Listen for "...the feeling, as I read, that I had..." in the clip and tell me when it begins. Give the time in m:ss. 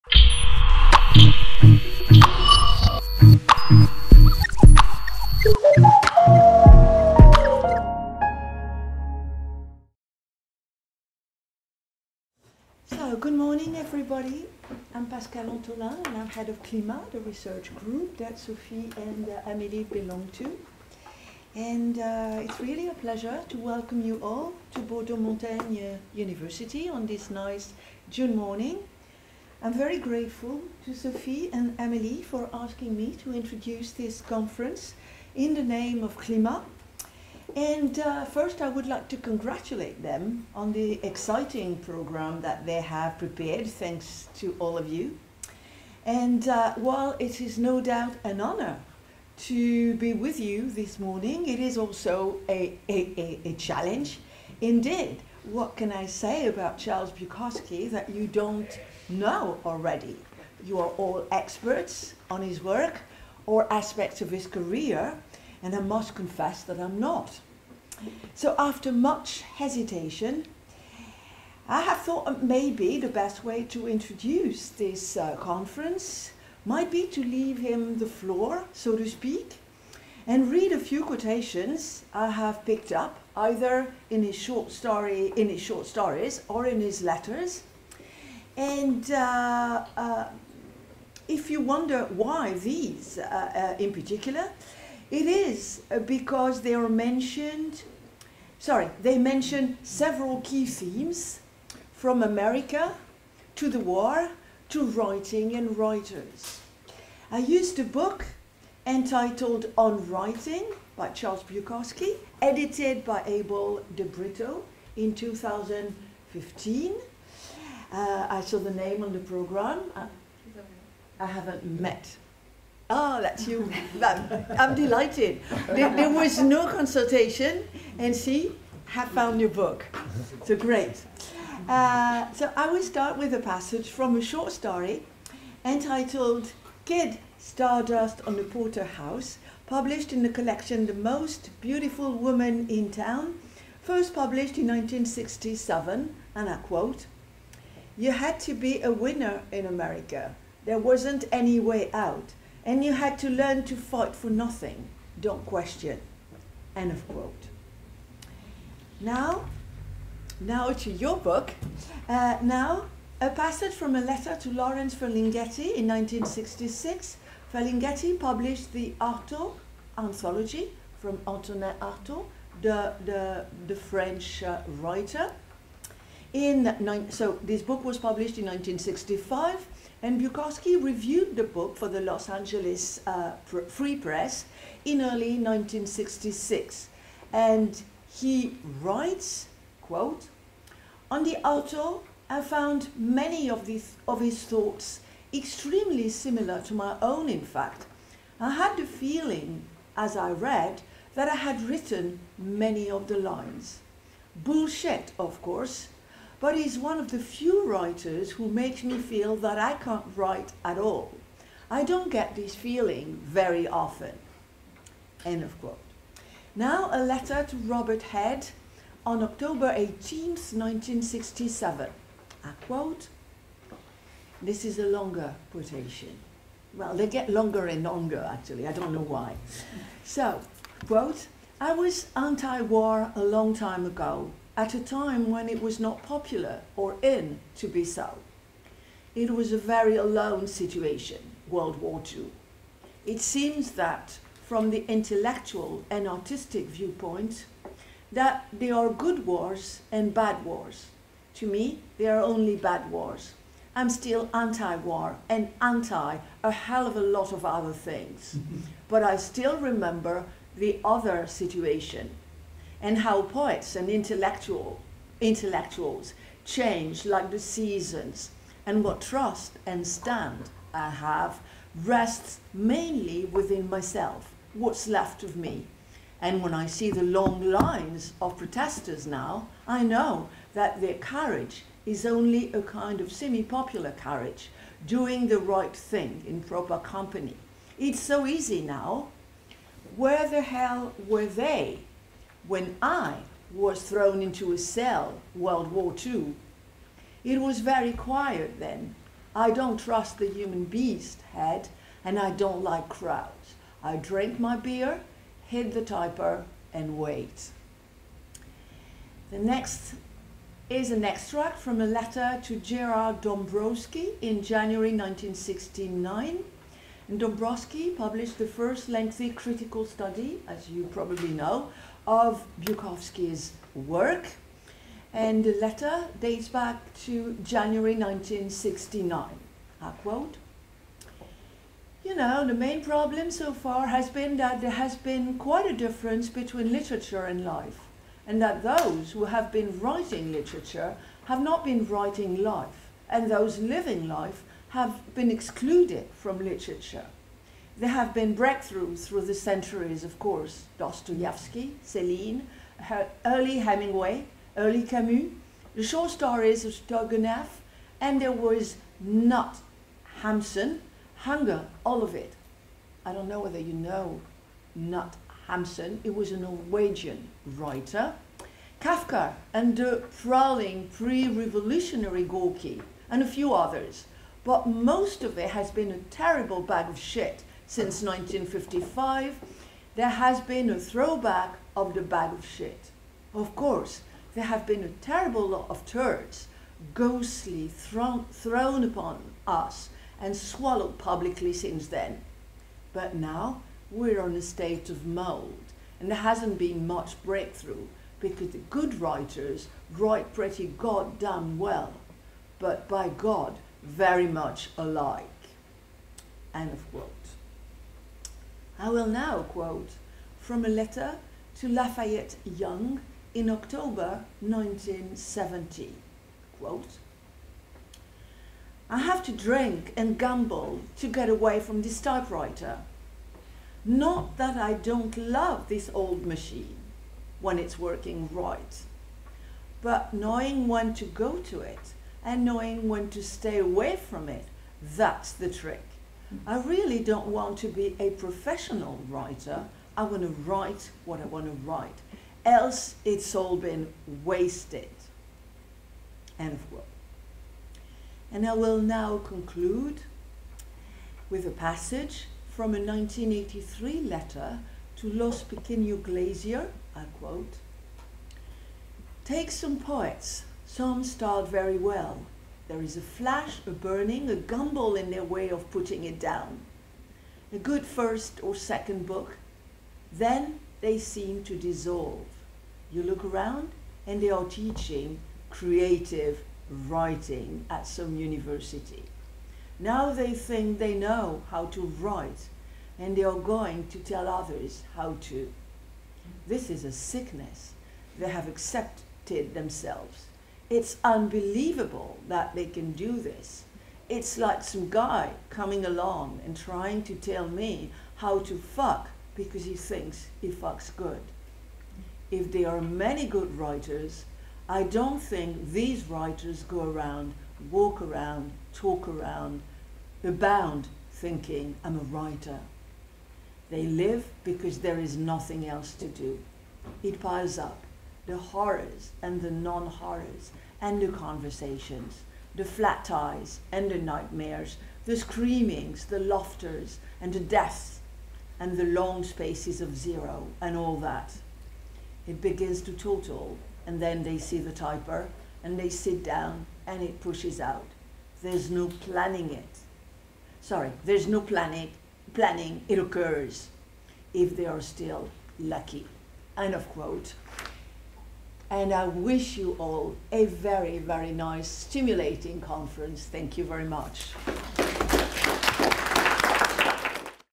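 3:18.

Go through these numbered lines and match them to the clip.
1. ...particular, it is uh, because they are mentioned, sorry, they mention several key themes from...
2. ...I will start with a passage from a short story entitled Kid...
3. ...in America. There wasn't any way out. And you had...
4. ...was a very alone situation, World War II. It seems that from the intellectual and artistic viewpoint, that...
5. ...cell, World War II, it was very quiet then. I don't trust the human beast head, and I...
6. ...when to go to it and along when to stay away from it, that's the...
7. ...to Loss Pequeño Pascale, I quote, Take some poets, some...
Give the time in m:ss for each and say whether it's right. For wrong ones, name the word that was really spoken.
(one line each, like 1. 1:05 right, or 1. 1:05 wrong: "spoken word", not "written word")
1. 1:33 right
2. 2:12 right
3. 2:29 right
4. 3:59 right
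5. 4:54 right
6. 7:10 wrong: "knowing", not "along"
7. 7:34 wrong: "Glazier", not "Pascale".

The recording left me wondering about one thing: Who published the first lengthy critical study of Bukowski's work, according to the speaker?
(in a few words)
Gerard Dombrowski.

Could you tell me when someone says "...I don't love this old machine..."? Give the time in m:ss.
7:04.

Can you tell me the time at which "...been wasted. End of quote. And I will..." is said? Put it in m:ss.
7:23.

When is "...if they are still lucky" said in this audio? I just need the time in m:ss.
9:04.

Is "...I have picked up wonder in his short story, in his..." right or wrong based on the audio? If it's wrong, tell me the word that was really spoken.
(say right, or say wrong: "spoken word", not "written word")
wrong: "either", not "wonder".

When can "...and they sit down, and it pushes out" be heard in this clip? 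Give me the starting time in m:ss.
8:55.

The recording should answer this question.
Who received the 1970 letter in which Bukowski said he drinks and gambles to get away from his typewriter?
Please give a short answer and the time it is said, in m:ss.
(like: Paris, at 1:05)
Lafayette Young, at 6:51.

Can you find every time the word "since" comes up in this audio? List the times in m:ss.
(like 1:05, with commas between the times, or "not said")
6:17, 6:31.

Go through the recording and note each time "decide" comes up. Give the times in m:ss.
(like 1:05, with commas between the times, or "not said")
not said.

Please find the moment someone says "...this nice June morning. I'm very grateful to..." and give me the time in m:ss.
0:27.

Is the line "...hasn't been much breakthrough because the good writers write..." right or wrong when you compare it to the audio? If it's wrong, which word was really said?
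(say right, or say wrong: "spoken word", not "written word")
right.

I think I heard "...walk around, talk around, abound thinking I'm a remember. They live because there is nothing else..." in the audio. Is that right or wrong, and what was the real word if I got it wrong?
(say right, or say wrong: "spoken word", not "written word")
wrong: "writer", not "remember".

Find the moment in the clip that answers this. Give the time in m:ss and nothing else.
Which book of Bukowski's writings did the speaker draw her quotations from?
1:49.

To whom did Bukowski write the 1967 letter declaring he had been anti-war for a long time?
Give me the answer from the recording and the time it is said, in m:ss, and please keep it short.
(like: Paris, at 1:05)
Robert Head, at 3:37.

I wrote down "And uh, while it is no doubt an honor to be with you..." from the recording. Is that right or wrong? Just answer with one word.
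right.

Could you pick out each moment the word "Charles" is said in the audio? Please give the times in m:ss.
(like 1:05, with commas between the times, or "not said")
0:56, 1:51.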